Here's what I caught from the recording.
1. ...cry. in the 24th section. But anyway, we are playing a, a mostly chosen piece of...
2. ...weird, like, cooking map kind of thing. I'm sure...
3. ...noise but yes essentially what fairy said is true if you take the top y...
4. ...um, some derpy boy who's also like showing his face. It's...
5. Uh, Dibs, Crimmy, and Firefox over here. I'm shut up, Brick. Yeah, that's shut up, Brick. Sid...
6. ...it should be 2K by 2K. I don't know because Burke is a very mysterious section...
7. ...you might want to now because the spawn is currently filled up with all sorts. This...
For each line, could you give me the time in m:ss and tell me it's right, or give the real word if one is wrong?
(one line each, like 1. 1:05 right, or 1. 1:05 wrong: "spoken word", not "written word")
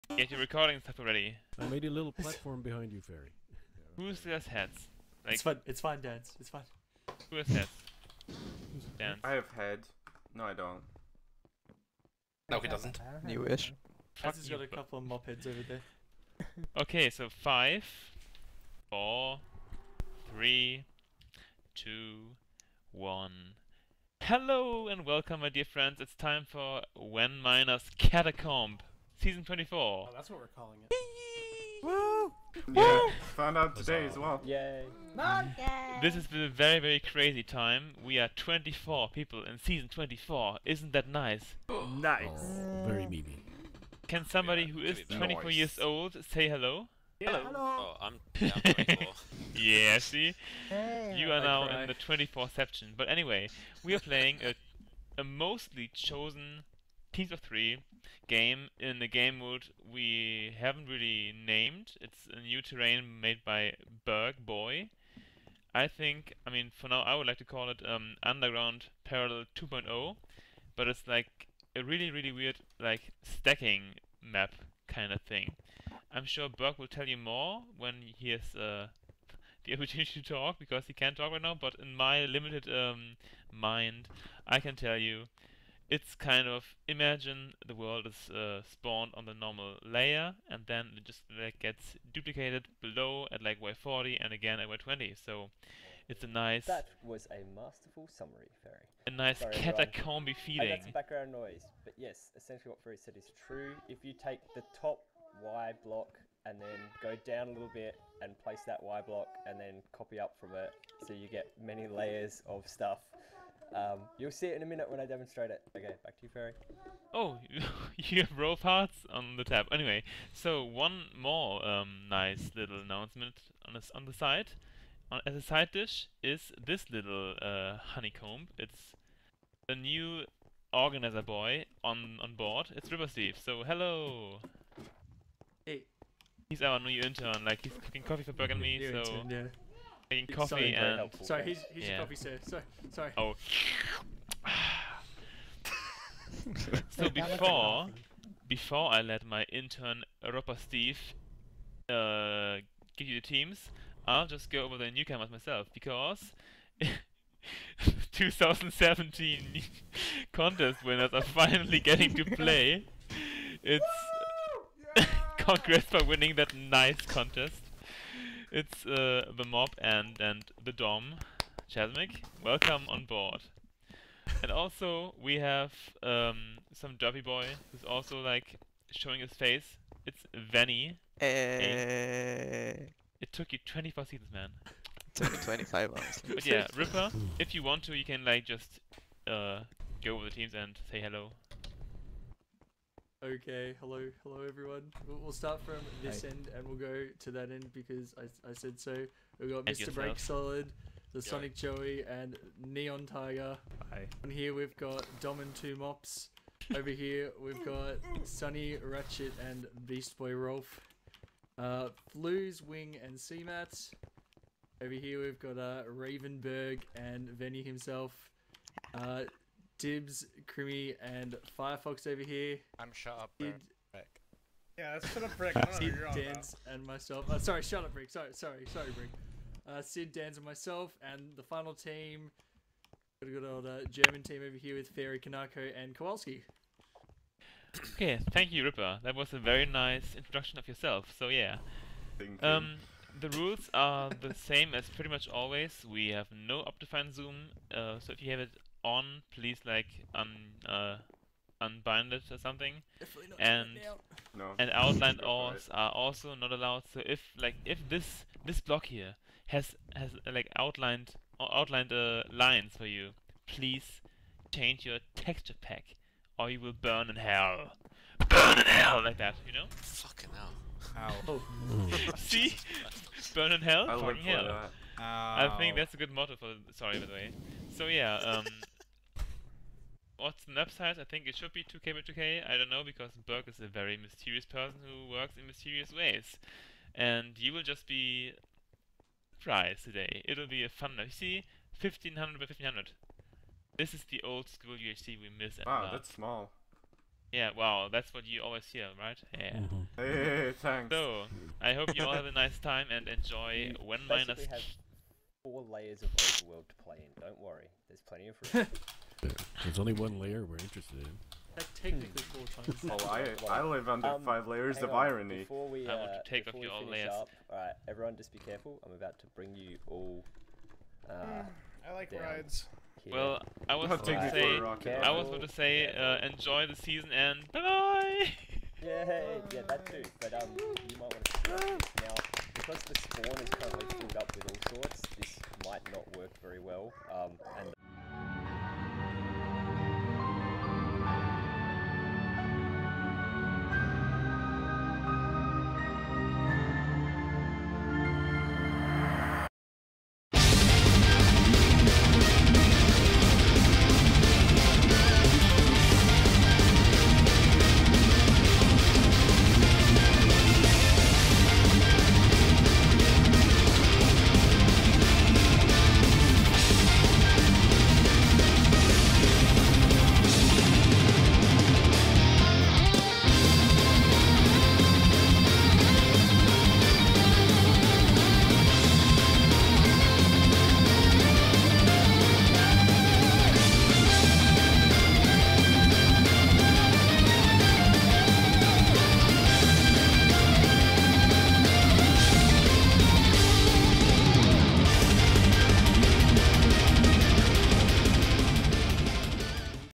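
1. 0:51 right
2. 1:12 wrong: "stacking", not "cooking"
3. 1:41 right
4. 2:56 right
5. 3:38 right
6. 4:41 wrong: "person", not "section"
7. 5:30 right.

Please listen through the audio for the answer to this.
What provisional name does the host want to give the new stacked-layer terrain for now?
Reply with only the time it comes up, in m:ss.
1:08.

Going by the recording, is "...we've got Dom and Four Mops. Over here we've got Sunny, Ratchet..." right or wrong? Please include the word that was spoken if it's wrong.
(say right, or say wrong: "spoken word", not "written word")
wrong: "Two", not "Four".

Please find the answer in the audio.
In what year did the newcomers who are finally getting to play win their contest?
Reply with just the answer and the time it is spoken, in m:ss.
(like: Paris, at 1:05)
2017, at 2:38.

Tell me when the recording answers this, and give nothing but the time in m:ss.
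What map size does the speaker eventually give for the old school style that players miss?
4:51.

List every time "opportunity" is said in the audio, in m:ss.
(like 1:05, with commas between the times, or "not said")
1:19.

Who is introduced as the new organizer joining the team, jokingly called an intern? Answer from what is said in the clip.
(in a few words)
River Steve.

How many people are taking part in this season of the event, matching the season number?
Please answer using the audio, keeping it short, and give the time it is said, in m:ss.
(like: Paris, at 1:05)
24, at 0:38.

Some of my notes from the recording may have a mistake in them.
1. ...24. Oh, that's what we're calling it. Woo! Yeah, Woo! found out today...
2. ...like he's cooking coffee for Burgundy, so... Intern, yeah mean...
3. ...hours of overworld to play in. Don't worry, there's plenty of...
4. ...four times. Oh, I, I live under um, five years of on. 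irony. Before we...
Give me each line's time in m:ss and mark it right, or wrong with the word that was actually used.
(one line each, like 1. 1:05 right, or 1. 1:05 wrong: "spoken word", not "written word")
1. 0:29 right
2. 2:17 right
3. 5:05 wrong: "layers", not "hours"
4. 5:12 wrong: "layers", not "years".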